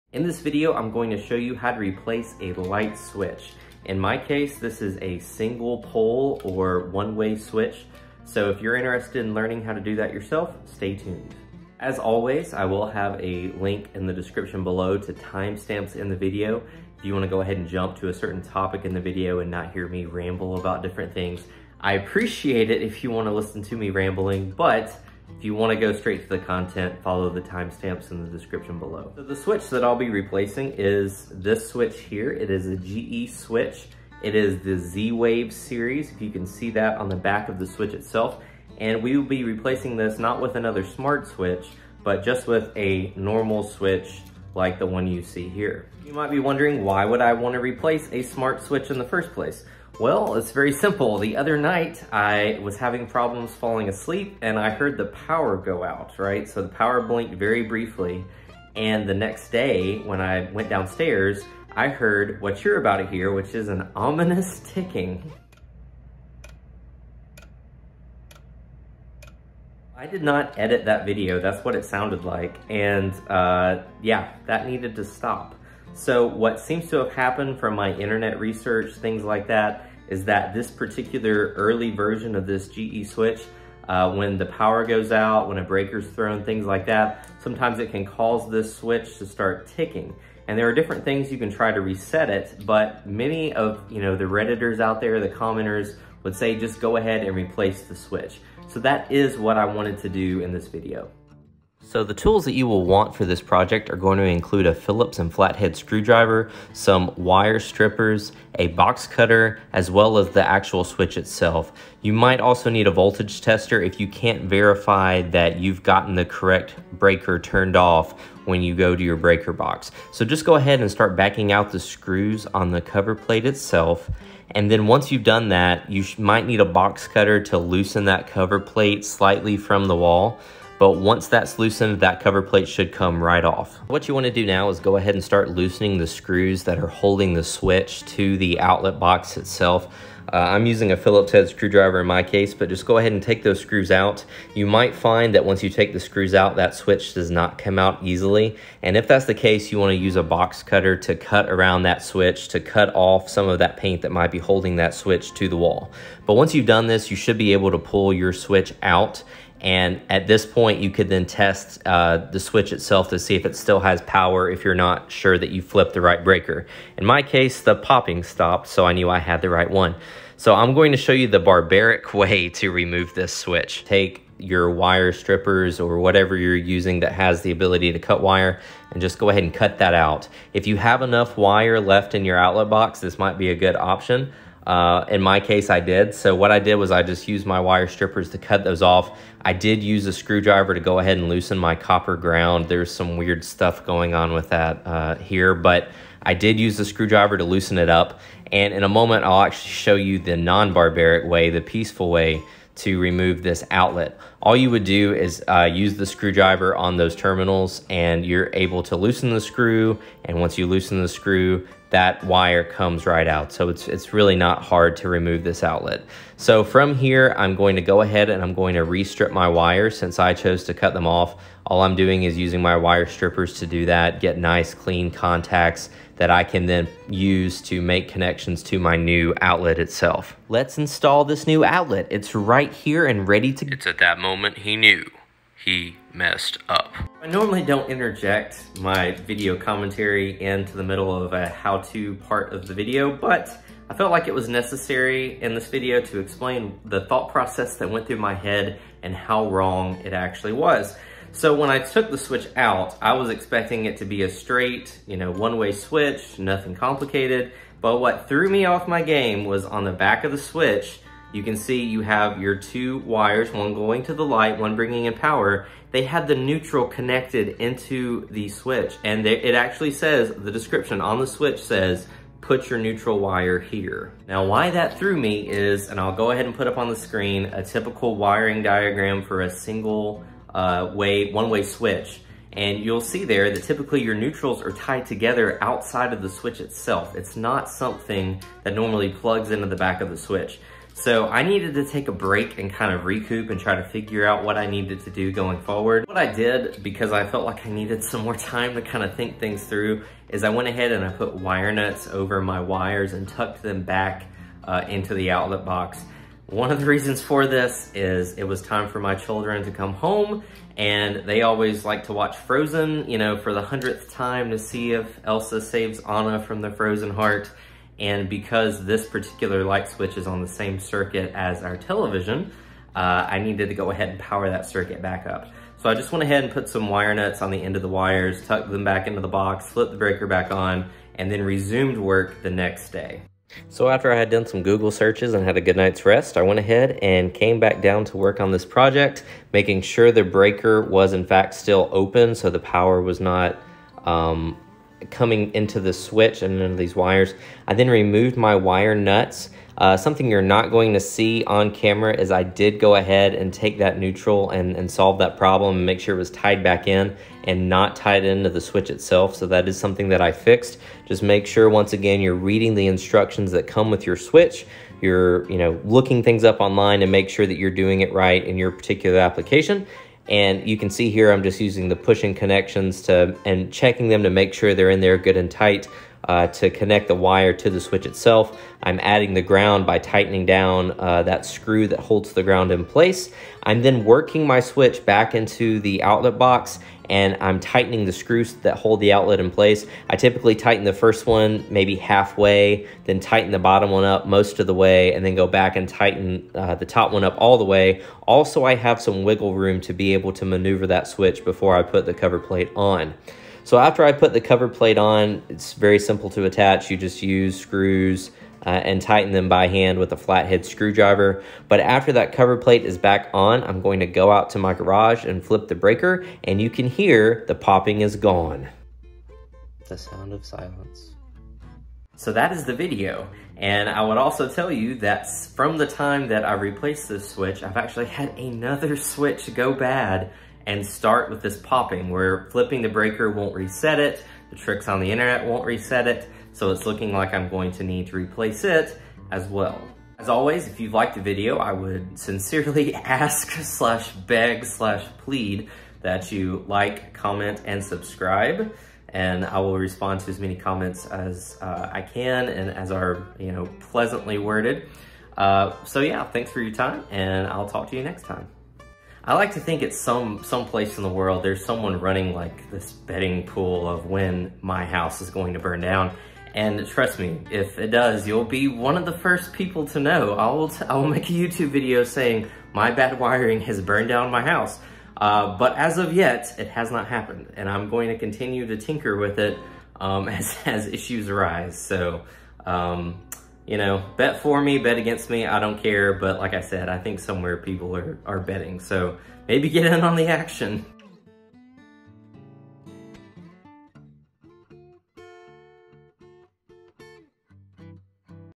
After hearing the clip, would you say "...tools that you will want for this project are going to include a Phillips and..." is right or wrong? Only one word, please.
right.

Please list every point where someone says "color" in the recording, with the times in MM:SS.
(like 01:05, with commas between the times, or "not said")
not said.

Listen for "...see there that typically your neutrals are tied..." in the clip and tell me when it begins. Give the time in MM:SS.
04:42.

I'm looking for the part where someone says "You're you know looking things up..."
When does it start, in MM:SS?
06:05.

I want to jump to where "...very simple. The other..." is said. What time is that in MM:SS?
00:50.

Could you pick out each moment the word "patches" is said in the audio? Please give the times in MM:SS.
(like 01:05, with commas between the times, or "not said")
not said.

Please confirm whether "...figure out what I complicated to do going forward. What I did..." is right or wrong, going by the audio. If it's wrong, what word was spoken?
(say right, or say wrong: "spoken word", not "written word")
wrong: "needed", not "complicated".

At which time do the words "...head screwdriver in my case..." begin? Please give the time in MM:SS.
02:21.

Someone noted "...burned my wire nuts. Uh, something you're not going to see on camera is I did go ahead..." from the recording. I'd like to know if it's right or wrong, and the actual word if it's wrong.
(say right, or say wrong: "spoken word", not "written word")
wrong: "removed", not "burned".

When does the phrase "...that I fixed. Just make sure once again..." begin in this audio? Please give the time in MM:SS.
06:00.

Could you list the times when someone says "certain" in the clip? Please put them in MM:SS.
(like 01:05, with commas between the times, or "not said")
00:18.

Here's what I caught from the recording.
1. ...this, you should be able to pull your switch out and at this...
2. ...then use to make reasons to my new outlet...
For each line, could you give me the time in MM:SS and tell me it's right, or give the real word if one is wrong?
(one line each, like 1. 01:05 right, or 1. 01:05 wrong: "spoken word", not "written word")
1. 02:36 right
2. 03:46 wrong: "connections", not "reasons".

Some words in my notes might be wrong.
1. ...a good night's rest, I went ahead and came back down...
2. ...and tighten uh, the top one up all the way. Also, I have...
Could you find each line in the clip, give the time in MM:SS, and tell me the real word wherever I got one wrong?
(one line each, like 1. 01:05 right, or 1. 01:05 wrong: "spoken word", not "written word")
1. 05:35 right
2. 06:35 right.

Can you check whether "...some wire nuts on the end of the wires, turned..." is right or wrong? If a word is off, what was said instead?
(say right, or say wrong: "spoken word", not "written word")
wrong: "tucked", not "turned".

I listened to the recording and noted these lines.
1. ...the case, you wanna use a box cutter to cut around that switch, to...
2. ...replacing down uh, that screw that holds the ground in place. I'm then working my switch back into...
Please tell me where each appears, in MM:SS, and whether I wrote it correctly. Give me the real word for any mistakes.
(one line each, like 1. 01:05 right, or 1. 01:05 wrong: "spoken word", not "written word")
1. 02:29 right
2. 06:19 wrong: "tightening", not "replacing".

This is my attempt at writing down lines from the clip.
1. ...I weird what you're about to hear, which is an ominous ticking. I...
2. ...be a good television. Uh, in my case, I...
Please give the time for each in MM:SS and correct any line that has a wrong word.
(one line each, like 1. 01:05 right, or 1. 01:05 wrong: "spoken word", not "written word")
1. 01:01 wrong: "heard", not "weird"
2. 03:03 wrong: "option", not "television".